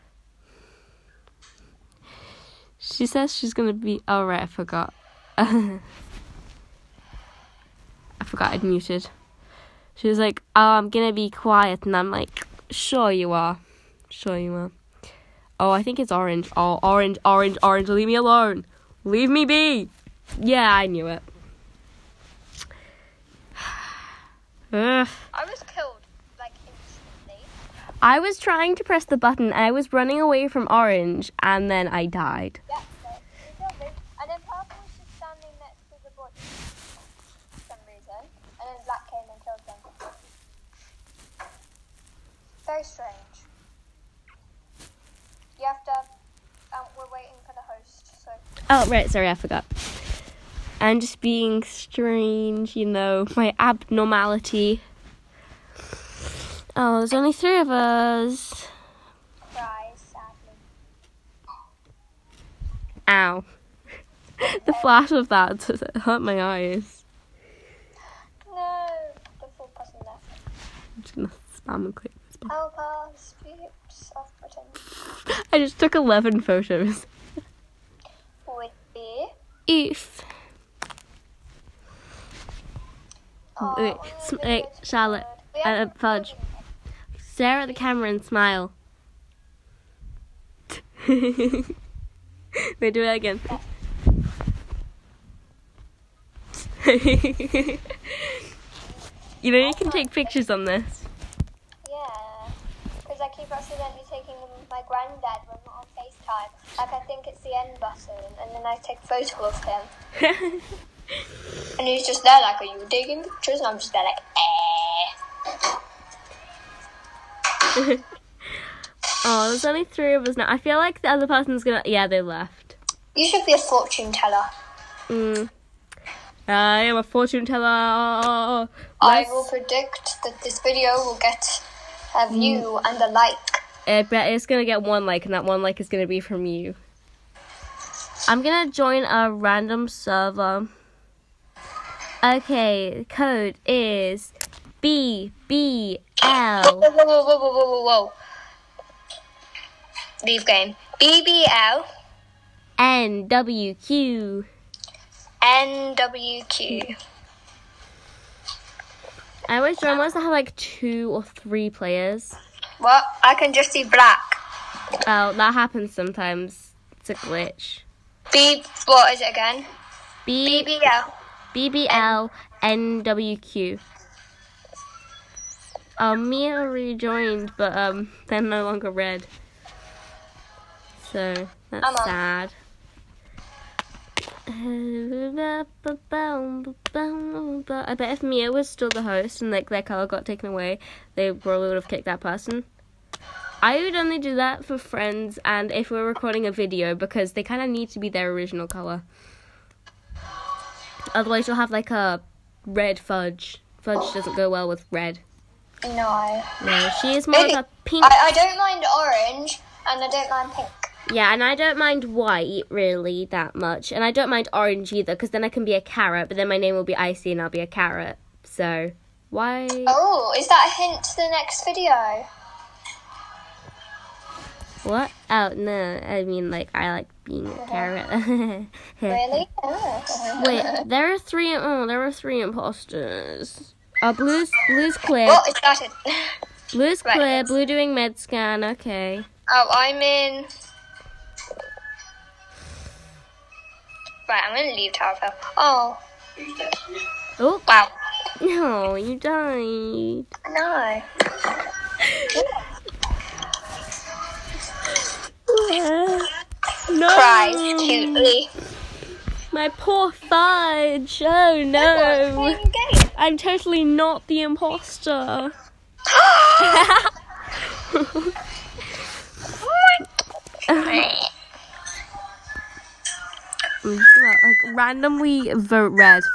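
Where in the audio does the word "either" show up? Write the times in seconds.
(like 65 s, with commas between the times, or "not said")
214 s.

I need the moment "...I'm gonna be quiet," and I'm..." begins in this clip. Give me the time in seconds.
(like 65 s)
10 s.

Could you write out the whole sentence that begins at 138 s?
I'm gonna join a random server.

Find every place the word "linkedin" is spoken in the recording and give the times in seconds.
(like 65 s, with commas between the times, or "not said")
not said.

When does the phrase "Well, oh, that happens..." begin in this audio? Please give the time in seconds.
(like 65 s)
165 s.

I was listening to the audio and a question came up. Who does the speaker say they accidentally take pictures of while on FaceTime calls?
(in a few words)
Granddad.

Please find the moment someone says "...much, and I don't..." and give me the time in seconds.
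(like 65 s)
213 s.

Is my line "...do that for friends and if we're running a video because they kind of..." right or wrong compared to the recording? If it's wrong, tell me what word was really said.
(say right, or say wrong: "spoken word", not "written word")
wrong: "recording", not "running".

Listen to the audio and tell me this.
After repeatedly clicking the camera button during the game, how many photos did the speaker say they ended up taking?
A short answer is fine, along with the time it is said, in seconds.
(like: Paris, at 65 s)
11, at 75 s.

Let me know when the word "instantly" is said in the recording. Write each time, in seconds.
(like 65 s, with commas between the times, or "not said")
26 s.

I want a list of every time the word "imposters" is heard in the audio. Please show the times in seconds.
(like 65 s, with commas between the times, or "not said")
232 s, 264 s.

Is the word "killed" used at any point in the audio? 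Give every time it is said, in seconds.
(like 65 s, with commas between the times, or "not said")
25 s.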